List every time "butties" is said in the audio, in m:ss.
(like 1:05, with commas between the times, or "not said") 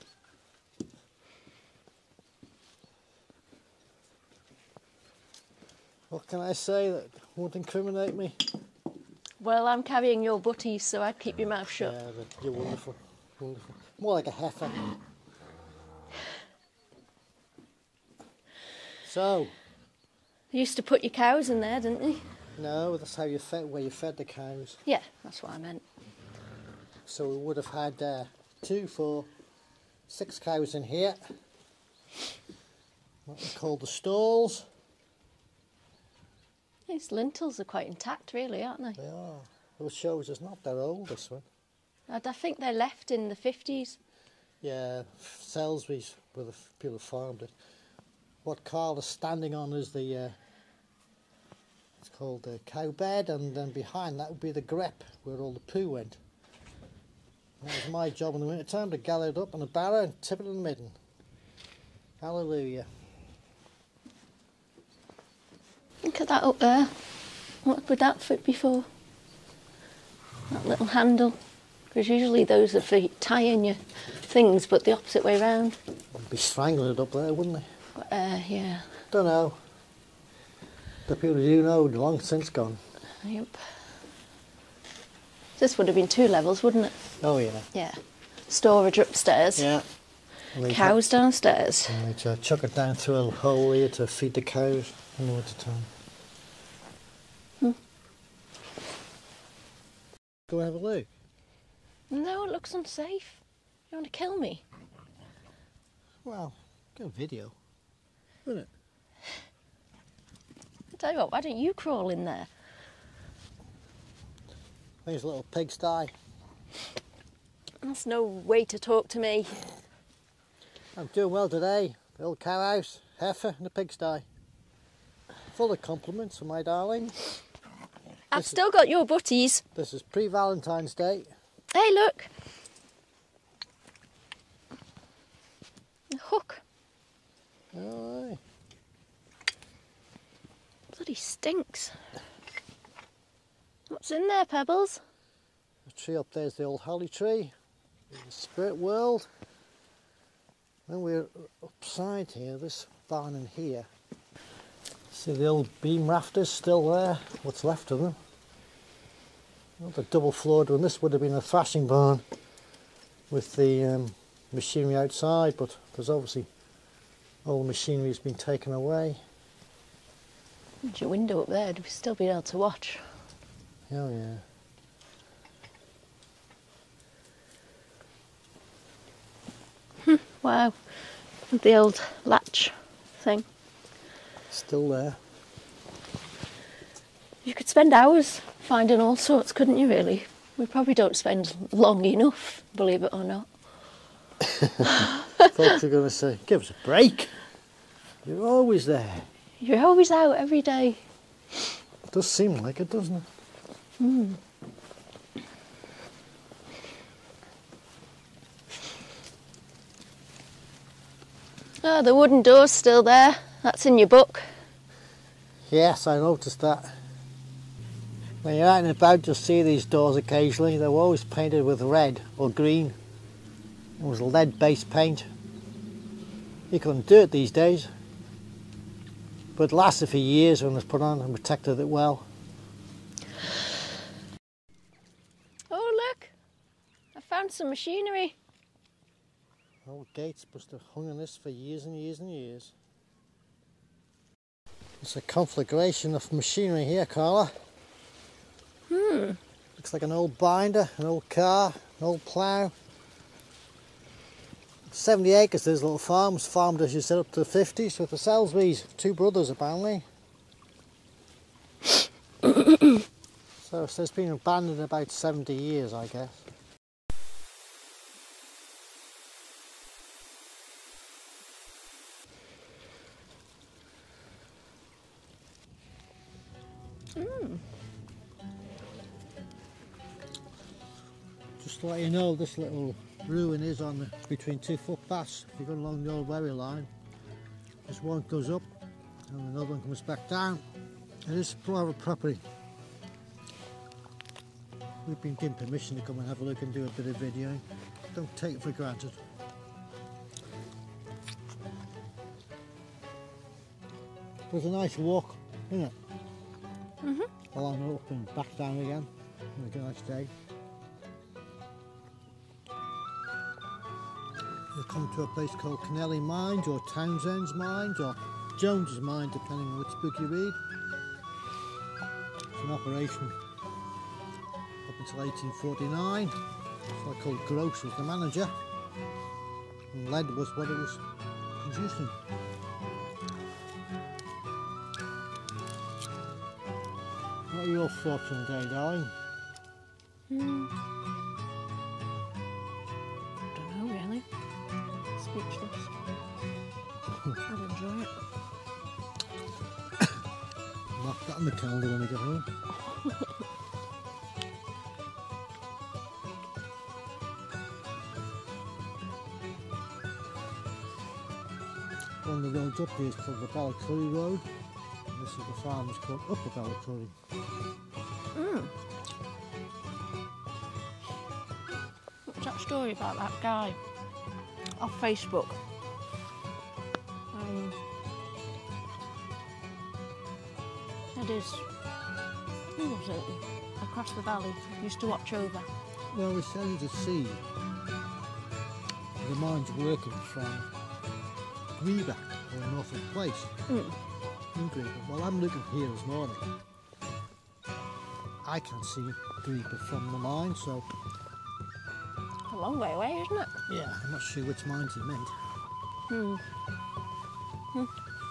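0:10, 2:09.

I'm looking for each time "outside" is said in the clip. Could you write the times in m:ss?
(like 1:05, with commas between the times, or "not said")
2:44.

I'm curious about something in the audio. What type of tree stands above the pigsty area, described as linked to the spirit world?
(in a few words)
holly tree.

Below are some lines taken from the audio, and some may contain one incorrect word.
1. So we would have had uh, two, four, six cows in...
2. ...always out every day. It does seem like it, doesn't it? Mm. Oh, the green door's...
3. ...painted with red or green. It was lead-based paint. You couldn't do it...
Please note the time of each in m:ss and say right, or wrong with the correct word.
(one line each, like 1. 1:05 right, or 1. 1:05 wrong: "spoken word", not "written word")
1. 0:27 right
2. 3:19 wrong: "wooden", not "green"
3. 3:41 right.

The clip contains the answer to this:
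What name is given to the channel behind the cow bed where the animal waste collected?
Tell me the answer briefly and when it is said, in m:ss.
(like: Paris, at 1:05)
grep, at 0:54.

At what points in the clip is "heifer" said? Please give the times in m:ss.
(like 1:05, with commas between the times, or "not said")
0:14, 2:03.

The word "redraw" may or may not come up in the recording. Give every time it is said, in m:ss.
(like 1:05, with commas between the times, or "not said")
not said.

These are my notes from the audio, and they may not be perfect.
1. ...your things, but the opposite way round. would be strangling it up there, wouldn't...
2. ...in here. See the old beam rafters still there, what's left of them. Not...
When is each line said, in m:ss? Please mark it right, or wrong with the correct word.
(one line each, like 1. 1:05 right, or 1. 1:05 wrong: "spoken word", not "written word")
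1. 1:13 right
2. 2:33 right.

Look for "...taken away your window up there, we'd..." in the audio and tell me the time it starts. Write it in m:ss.
2:48.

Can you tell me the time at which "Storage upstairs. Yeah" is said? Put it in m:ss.
1:28.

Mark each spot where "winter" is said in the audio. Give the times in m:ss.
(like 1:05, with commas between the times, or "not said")
0:58, 1:35.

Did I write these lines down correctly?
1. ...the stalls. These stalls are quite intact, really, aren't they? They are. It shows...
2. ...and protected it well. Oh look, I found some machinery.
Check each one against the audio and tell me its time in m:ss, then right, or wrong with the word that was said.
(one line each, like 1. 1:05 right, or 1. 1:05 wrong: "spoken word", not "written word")
1. 0:33 wrong: "lintels", not "stalls"
2. 3:51 right.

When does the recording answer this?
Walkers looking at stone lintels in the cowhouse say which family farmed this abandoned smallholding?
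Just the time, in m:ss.
0:45.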